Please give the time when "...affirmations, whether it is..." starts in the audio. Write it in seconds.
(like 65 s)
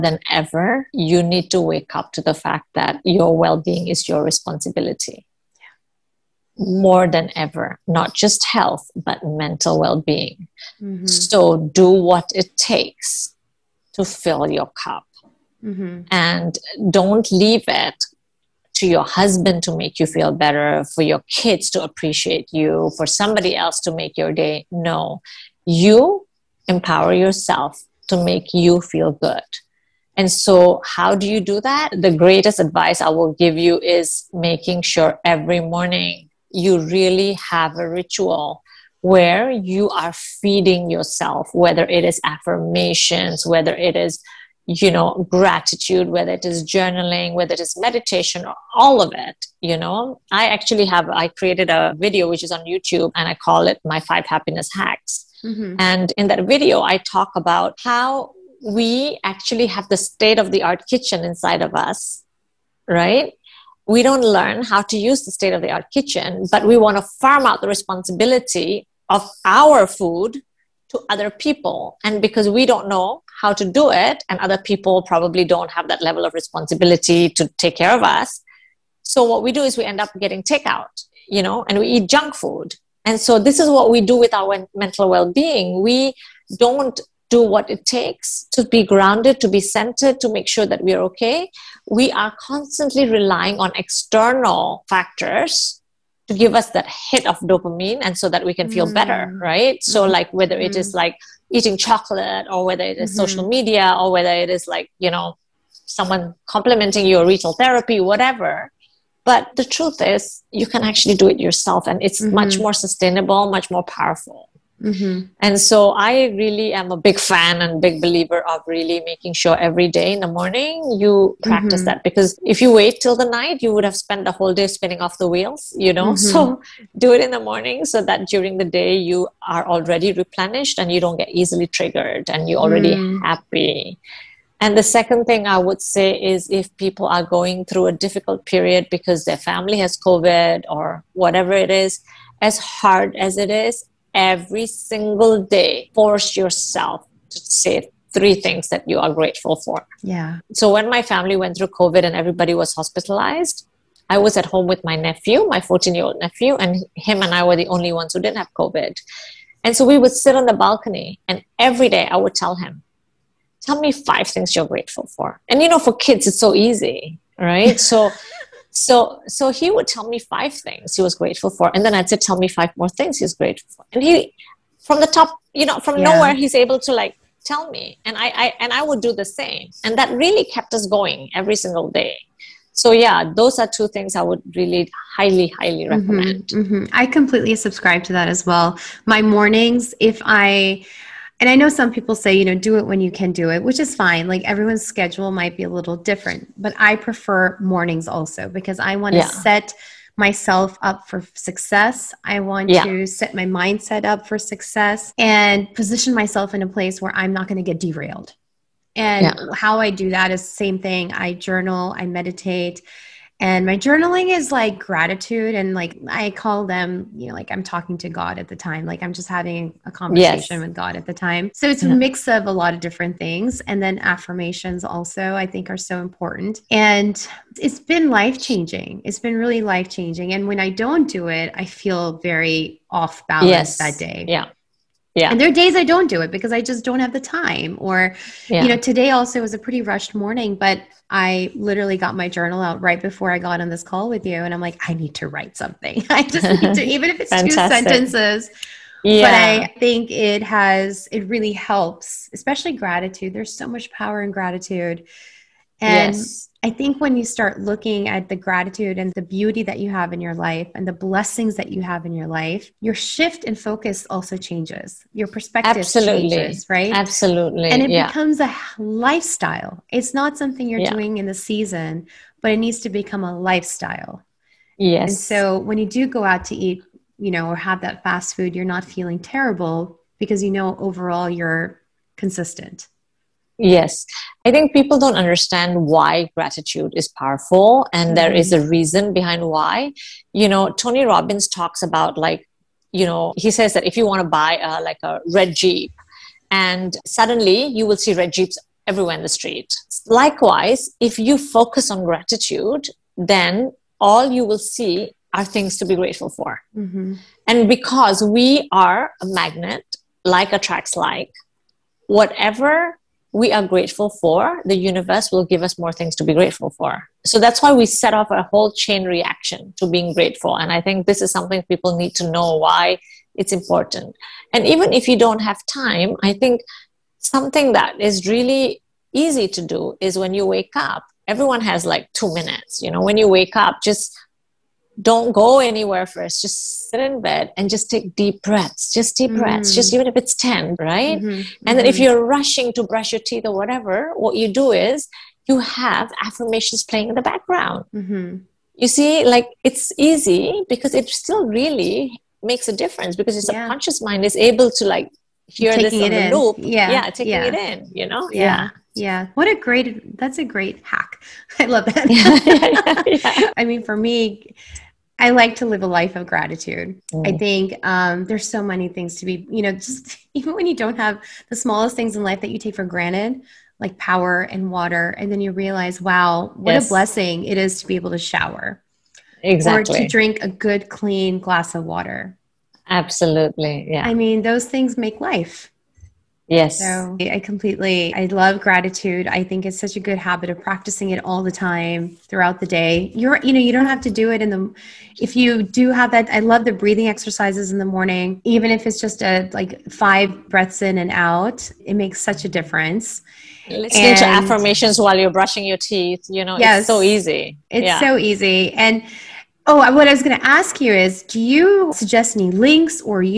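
42 s.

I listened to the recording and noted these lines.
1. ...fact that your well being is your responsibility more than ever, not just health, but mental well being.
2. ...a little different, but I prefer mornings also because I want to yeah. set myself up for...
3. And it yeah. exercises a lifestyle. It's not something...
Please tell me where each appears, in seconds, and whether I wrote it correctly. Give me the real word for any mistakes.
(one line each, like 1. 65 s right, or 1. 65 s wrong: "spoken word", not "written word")
1. 2 s right
2. 195 s right
3. 267 s wrong: "becomes", not "exercises".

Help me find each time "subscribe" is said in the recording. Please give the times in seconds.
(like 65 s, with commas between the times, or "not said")
187 s.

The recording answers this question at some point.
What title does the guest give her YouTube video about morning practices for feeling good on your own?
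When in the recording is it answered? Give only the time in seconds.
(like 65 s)
53 s.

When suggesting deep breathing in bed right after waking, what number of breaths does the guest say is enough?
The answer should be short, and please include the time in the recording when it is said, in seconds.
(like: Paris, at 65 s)
10, at 340 s.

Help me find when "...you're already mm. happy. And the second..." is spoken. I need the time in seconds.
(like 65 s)
132 s.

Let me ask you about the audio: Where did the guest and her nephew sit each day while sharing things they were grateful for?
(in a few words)
the balcony.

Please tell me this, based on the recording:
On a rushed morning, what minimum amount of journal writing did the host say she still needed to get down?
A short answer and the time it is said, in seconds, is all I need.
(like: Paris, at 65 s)
2 sentences, at 247 s.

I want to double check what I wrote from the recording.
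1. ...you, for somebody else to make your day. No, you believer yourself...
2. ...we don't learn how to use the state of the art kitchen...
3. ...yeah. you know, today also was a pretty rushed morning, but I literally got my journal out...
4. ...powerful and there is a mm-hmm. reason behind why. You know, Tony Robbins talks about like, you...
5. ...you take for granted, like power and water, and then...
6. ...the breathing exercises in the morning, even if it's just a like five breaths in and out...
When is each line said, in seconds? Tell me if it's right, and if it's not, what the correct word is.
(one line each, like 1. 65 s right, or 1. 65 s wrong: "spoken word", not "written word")
1. 22 s wrong: "empower", not "believer"
2. 63 s right
3. 238 s right
4. 287 s right
5. 372 s right
6. 396 s right.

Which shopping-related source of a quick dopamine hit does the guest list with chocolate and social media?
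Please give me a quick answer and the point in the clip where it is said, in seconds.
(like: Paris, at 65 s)
retail therapy, at 107 s.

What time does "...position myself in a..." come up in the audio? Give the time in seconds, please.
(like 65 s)
205 s.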